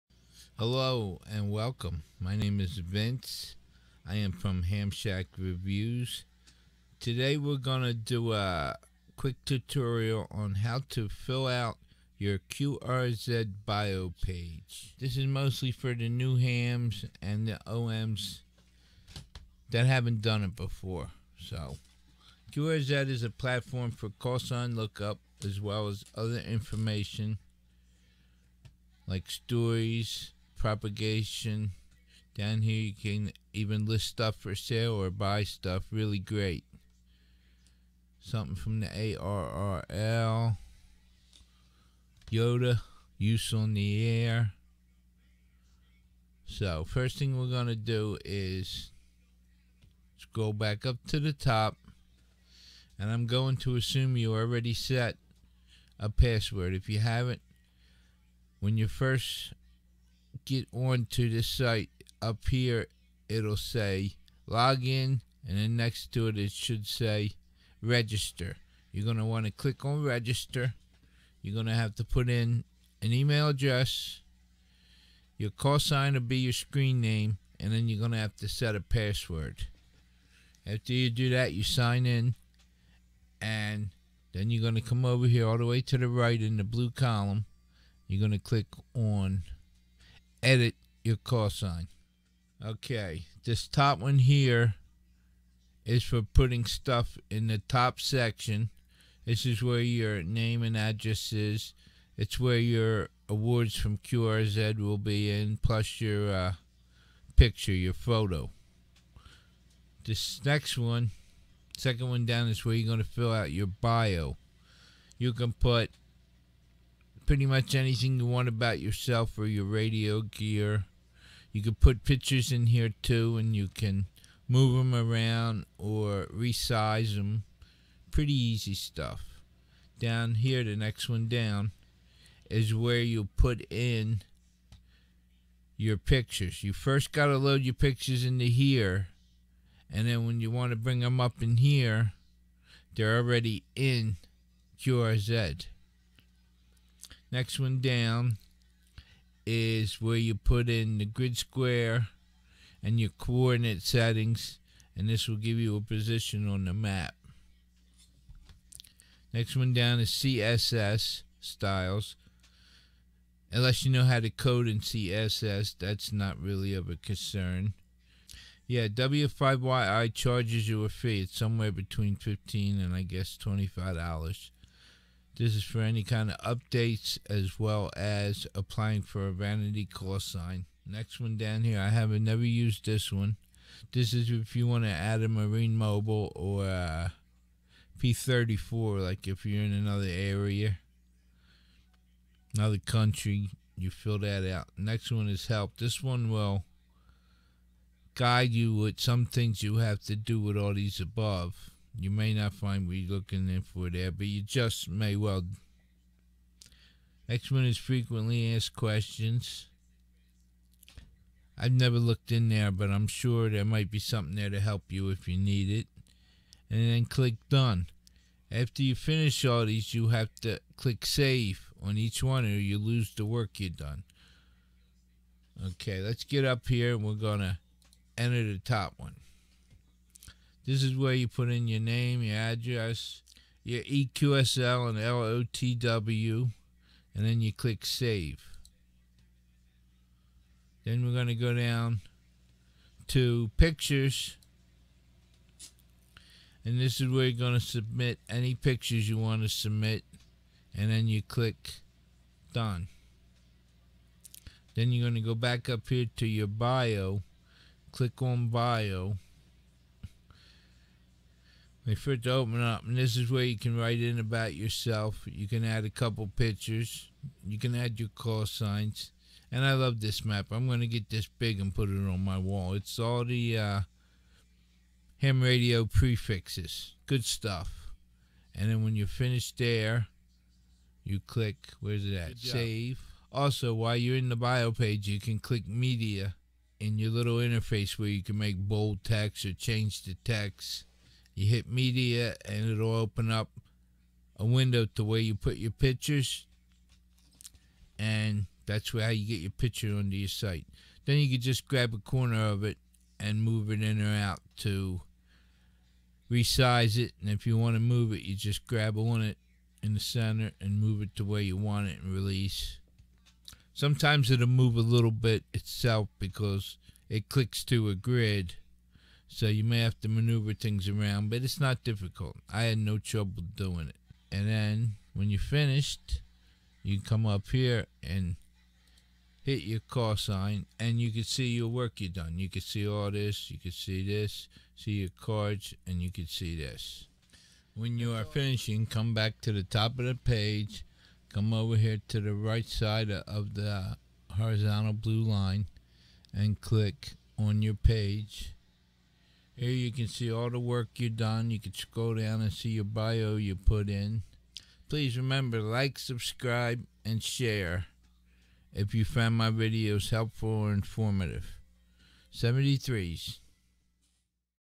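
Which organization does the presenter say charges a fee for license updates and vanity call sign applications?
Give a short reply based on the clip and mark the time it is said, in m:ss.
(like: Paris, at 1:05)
W5YI, at 2:48.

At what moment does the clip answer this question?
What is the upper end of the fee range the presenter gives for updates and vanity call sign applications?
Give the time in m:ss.
2:53.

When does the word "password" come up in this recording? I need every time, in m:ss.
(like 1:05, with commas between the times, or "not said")
0:56, 1:18.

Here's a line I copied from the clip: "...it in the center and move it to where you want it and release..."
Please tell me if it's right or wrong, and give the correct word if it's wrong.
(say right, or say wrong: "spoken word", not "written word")
right.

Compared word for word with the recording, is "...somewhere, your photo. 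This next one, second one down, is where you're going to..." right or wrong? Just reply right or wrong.
wrong.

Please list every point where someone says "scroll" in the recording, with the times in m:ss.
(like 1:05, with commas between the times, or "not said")
0:50, 5:51.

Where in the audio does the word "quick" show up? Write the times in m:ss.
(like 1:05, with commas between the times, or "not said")
0:09.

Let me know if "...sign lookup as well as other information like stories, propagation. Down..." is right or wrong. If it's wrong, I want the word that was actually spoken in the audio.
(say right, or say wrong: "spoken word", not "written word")
right.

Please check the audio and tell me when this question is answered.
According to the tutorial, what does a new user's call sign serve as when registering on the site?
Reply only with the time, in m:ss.
1:16.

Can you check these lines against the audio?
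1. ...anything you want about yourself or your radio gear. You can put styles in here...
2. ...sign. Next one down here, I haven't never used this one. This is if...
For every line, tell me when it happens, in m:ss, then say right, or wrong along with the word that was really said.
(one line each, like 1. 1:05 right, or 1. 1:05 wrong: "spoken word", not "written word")
1. 1:57 wrong: "pictures", not "styles"
2. 3:00 right.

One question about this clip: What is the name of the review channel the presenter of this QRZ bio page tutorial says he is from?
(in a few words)
Hamshack Reviews.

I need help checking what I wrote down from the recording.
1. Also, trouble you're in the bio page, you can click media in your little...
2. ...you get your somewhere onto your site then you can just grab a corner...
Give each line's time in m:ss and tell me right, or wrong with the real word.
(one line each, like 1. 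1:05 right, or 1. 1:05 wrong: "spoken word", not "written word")
1. 4:43 wrong: "while", not "trouble"
2. 4:59 wrong: "picture", not "somewhere".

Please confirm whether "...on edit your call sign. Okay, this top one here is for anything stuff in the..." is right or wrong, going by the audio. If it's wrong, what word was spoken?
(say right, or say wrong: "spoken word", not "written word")
wrong: "putting", not "anything".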